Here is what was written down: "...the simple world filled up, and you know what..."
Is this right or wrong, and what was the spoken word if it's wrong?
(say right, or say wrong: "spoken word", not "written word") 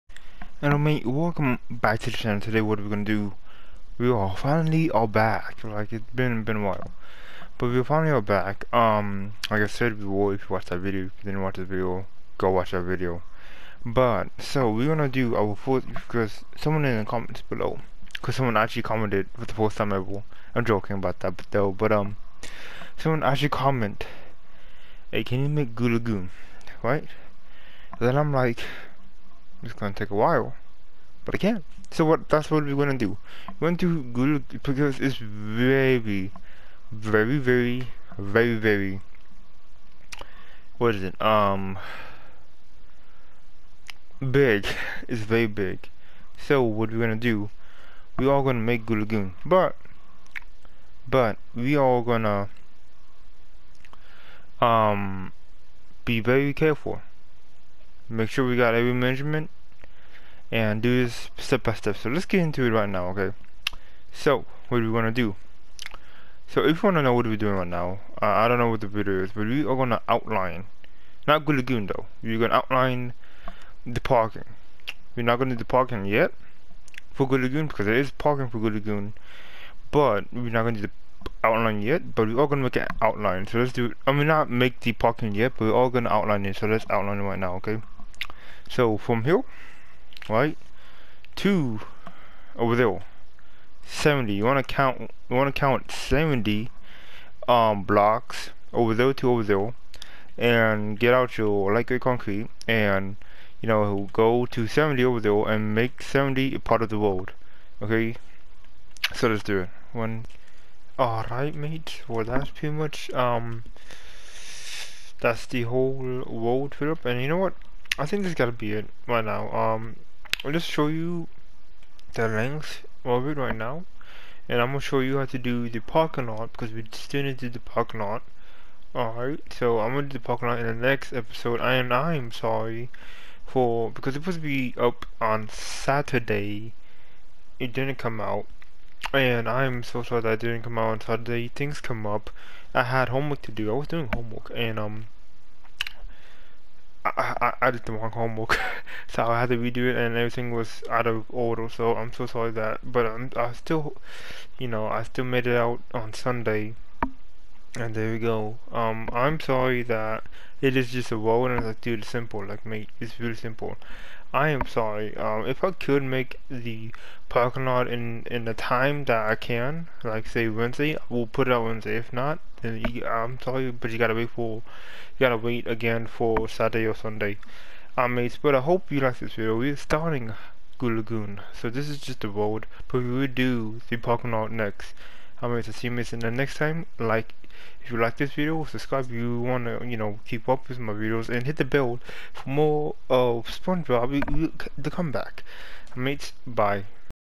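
wrong: "whole", not "simple".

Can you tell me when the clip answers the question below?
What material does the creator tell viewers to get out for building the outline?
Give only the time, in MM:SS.
01:41.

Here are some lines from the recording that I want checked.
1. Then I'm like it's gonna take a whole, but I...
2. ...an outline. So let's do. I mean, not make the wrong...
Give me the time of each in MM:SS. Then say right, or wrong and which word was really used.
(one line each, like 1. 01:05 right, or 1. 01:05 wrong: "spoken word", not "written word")
1. 00:27 wrong: "while", not "whole"
2. 01:22 wrong: "parking", not "wrong".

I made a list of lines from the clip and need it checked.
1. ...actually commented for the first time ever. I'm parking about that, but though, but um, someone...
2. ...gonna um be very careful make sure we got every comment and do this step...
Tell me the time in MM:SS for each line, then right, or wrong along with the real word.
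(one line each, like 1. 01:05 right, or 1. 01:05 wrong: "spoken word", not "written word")
1. 00:18 wrong: "joking", not "parking"
2. 00:52 wrong: "measurement", not "comment".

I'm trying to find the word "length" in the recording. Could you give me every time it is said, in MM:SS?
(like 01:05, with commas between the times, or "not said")
02:02.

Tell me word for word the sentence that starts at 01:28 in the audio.
So from here, right, to over there, 70.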